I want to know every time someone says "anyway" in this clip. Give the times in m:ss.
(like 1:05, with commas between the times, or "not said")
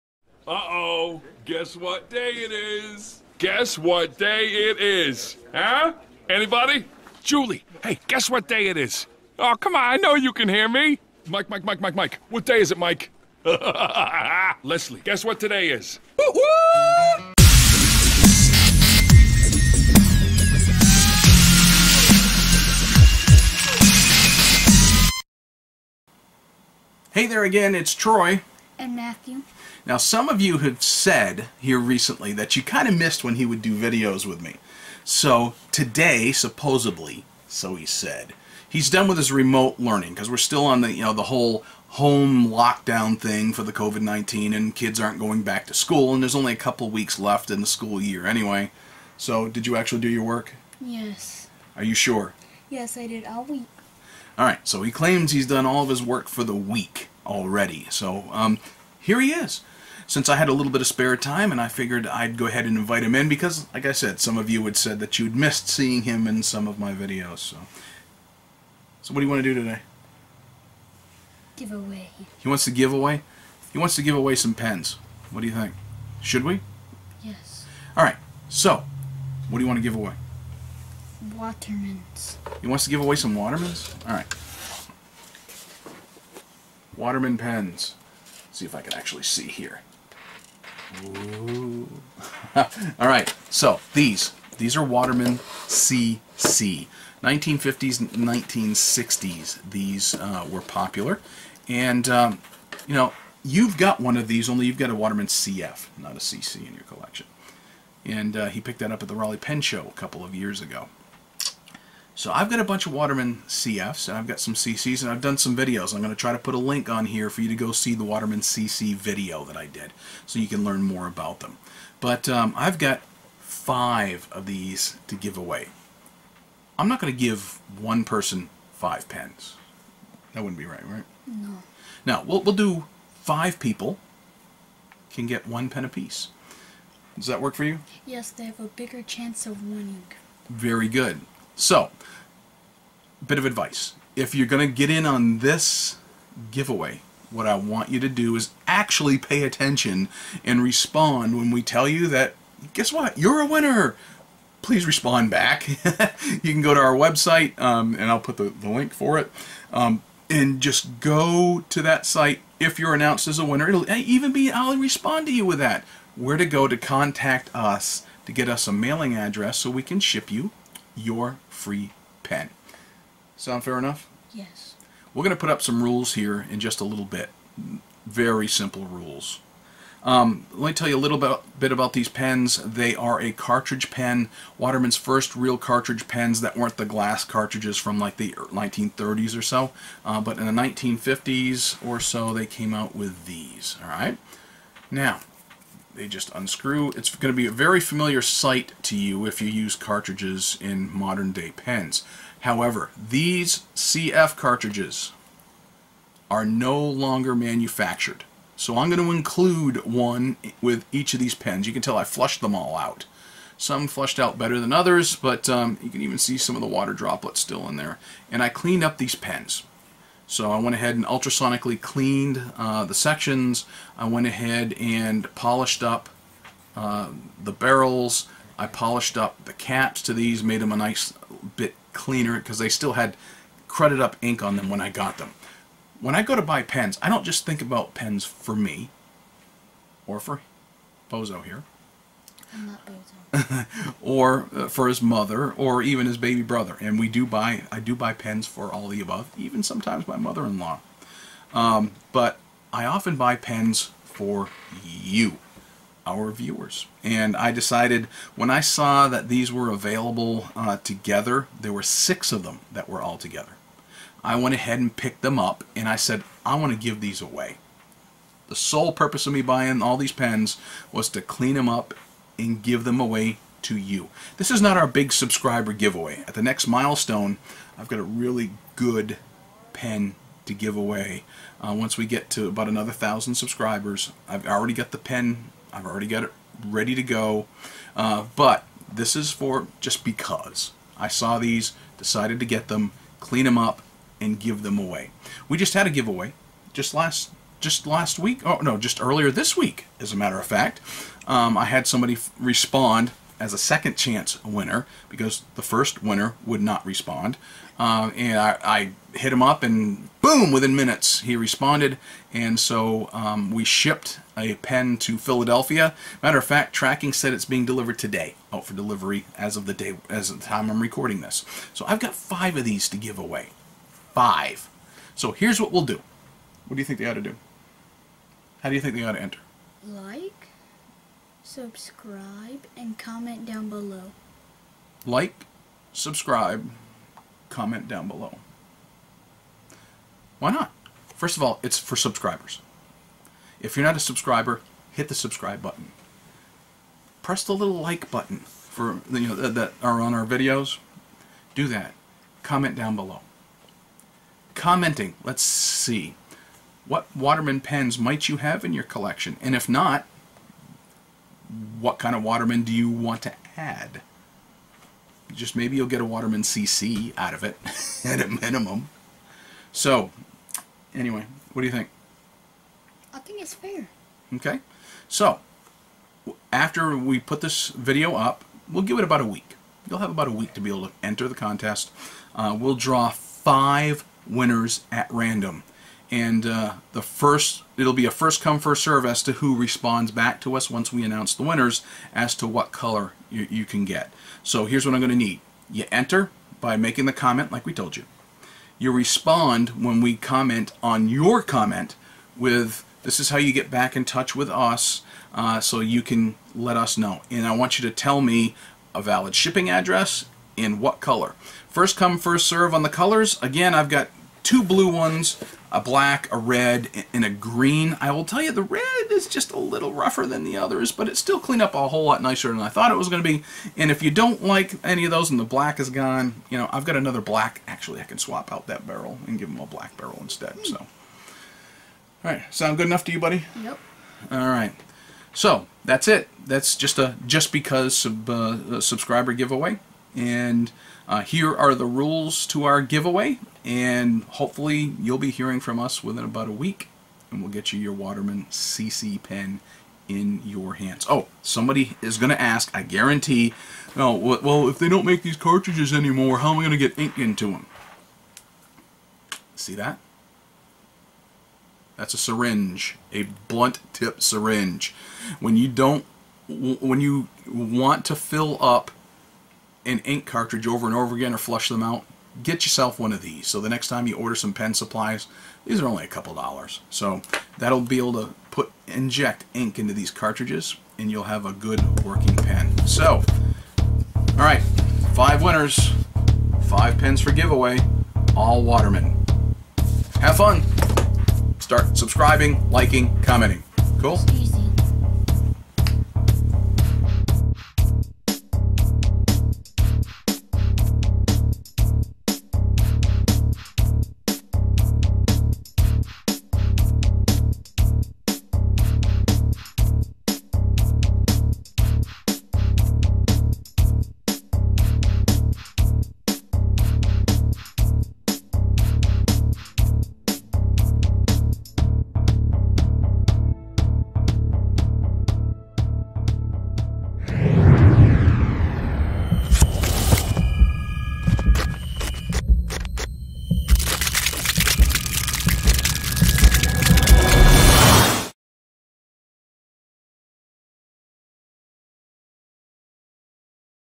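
0:48, 6:10.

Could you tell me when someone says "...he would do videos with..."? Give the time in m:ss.
0:33.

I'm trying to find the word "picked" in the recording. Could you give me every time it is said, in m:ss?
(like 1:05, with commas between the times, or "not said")
1:48, 4:24.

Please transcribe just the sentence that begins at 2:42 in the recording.
If you're announced as a winner, it'll even be, I'll respond to you with that.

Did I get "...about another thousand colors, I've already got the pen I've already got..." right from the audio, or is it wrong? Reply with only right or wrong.
wrong.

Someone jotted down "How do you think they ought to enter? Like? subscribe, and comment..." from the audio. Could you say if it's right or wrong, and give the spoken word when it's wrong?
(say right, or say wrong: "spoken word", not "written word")
right.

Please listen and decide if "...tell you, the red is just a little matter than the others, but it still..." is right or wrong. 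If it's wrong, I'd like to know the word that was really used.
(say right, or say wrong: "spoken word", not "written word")
wrong: "rougher", not "matter".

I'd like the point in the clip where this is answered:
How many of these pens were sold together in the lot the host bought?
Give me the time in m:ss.
4:21.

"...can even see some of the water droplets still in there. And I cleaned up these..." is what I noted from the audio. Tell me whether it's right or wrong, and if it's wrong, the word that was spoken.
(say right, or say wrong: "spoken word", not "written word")
right.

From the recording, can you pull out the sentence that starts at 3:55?
When I go to buy pens, I don't just think about pens for me or for Bozo here.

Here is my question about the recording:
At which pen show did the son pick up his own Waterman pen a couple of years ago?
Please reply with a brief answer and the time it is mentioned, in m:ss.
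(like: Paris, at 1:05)
Raleigh Pen Show, at 1:49.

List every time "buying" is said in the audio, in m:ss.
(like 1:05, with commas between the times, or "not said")
4:29.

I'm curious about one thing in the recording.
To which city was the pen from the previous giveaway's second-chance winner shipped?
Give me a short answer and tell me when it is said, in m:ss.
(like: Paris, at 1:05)
Philadelphia, at 5:15.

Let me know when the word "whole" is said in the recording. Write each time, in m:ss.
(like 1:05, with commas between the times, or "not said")
0:41, 7:01.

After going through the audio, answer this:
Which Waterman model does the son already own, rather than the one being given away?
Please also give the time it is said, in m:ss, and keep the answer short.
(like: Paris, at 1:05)
Waterman CF, at 1:44.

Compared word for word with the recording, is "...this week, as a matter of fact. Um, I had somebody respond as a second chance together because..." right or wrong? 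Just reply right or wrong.
wrong.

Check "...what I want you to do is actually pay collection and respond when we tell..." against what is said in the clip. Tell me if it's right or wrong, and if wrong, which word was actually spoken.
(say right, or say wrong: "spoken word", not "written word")
wrong: "attention", not "collection".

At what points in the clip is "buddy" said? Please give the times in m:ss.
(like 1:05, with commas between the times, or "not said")
7:13.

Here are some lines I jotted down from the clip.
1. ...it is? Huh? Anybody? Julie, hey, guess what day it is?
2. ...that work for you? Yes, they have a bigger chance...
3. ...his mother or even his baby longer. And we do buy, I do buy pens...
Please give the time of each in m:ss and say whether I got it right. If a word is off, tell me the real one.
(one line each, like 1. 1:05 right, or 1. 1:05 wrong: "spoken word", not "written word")
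1. 0:04 right
2. 2:17 right
3. 4:04 wrong: "brother", not "longer".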